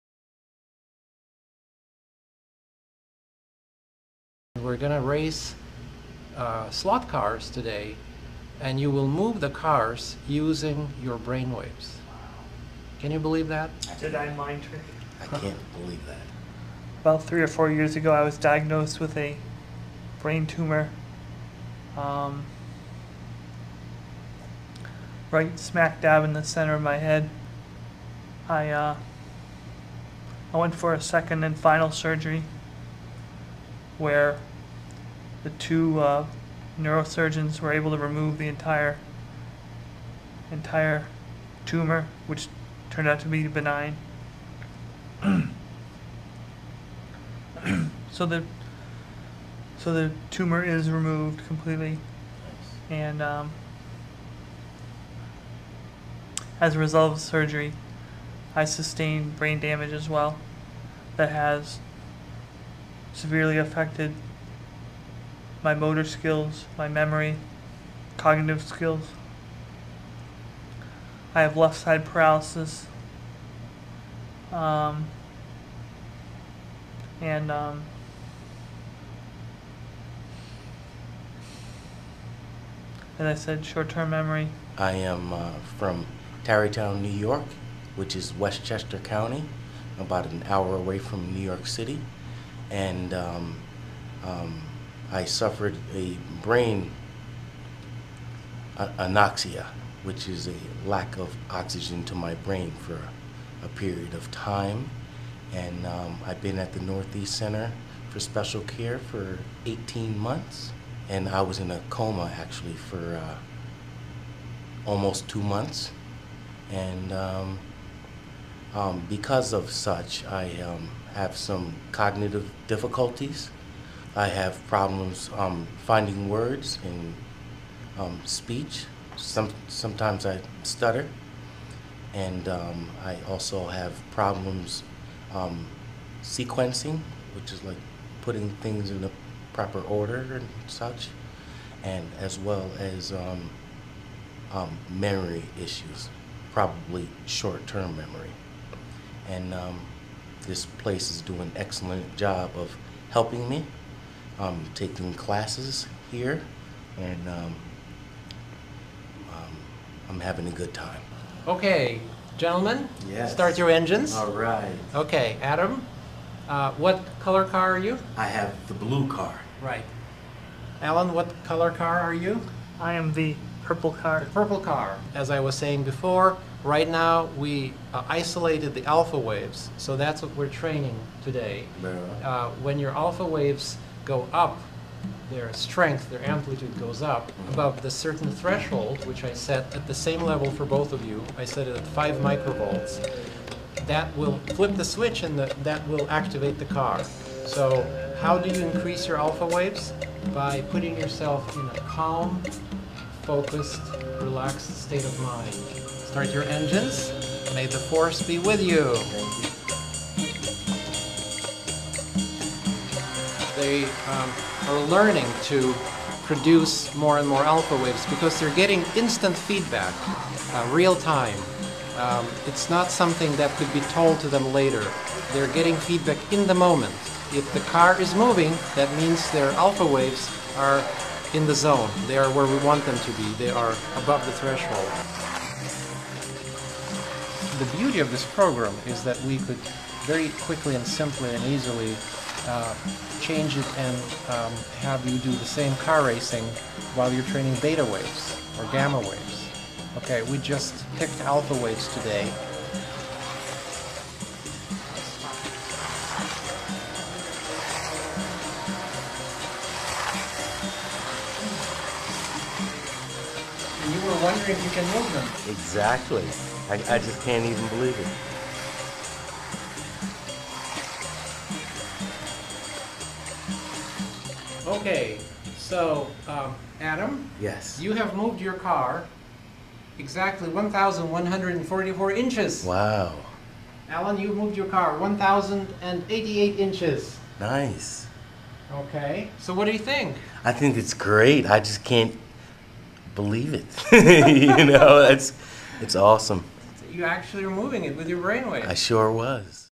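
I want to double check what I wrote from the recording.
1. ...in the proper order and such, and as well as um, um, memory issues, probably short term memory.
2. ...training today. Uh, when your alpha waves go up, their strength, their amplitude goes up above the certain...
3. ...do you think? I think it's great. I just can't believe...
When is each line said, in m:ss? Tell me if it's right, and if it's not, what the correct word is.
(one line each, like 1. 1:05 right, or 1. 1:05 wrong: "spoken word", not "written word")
1. 2:18 right
2. 3:00 right
3. 4:49 right.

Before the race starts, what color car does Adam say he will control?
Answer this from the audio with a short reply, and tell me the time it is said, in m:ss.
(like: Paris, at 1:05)
Blue, at 2:48.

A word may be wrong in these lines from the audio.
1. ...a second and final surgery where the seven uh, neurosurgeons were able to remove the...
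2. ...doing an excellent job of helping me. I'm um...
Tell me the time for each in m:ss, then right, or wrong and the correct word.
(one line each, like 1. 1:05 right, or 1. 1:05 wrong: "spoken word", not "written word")
1. 0:30 wrong: "two", not "seven"
2. 2:31 right.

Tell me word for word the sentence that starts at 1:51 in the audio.
And I was in a coma actually for uh, almost two months.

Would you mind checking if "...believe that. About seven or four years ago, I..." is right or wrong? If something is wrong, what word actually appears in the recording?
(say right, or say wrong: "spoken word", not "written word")
wrong: "three", not "seven".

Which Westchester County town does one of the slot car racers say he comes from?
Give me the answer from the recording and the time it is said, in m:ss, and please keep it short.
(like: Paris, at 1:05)
Tarrytown, at 1:26.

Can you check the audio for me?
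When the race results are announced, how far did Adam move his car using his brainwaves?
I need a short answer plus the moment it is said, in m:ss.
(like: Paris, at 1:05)
1,144 inches, at 4:40.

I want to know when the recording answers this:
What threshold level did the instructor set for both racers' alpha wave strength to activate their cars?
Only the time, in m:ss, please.
3:11.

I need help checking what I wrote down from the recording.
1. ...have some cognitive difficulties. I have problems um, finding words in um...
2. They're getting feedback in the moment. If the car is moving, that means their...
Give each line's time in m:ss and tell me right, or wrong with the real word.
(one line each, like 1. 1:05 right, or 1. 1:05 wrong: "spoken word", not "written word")
1. 2:01 right
2. 3:45 right.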